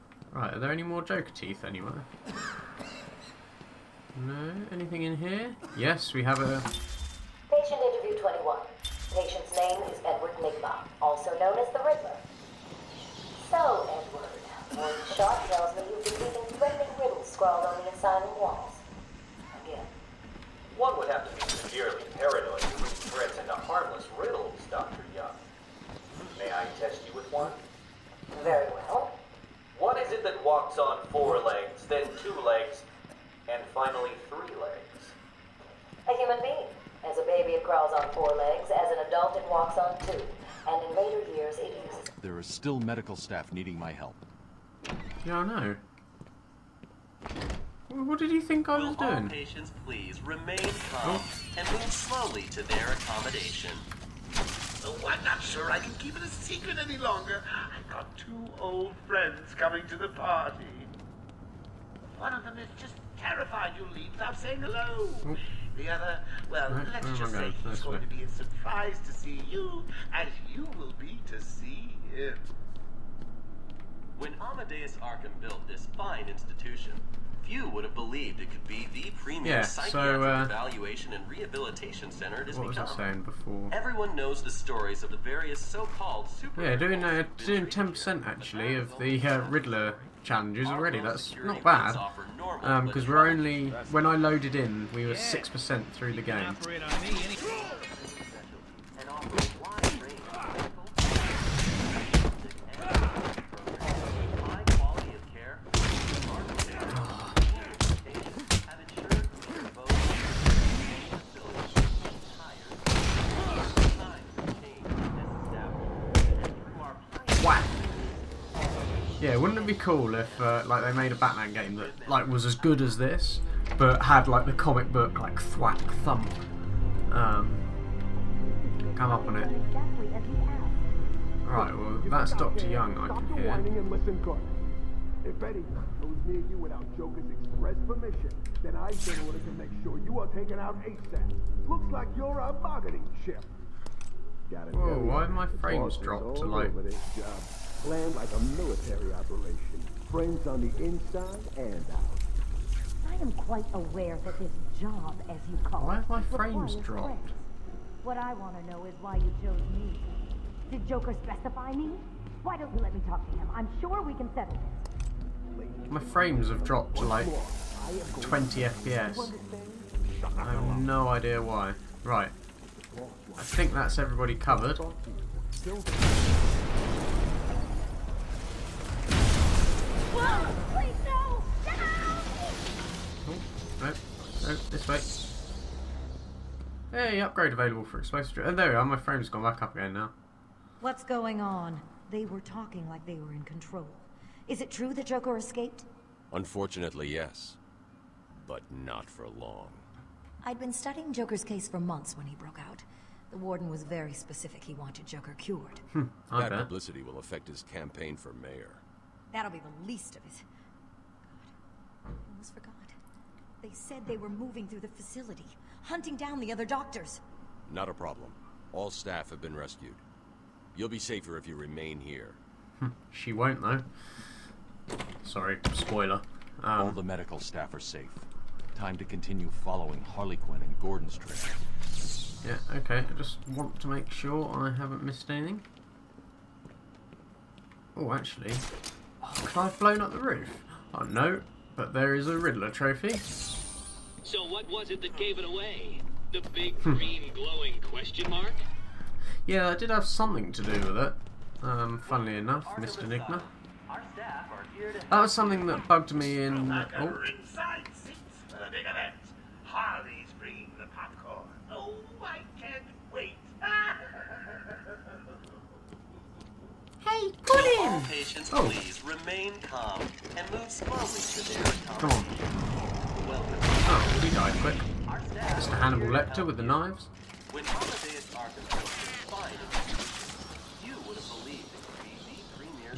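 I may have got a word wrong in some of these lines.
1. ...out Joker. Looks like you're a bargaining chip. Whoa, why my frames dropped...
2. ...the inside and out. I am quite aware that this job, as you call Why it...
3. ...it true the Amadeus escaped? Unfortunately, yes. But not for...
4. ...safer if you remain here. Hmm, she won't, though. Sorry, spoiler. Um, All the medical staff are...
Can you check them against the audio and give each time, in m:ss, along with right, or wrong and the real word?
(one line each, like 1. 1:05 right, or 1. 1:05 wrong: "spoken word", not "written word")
1. 2:20 wrong: "ASAP", not "Joker"
2. 2:30 right
3. 3:14 wrong: "Joker", not "Amadeus"
4. 3:40 right.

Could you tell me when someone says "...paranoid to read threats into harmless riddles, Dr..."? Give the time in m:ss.
0:22.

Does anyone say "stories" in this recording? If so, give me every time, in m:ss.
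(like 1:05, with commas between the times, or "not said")
1:24.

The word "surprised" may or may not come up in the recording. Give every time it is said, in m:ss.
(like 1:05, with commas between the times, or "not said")
1:08.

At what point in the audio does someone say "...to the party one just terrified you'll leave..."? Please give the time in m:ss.
0:59.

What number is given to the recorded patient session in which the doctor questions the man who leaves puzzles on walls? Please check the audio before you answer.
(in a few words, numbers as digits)
21.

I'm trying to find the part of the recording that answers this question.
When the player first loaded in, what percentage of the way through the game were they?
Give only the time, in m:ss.
1:35.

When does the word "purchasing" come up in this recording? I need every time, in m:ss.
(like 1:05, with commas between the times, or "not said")
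not said.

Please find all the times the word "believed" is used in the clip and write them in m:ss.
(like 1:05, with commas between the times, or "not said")
1:17, 4:41.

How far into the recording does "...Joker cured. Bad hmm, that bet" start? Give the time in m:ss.
3:25.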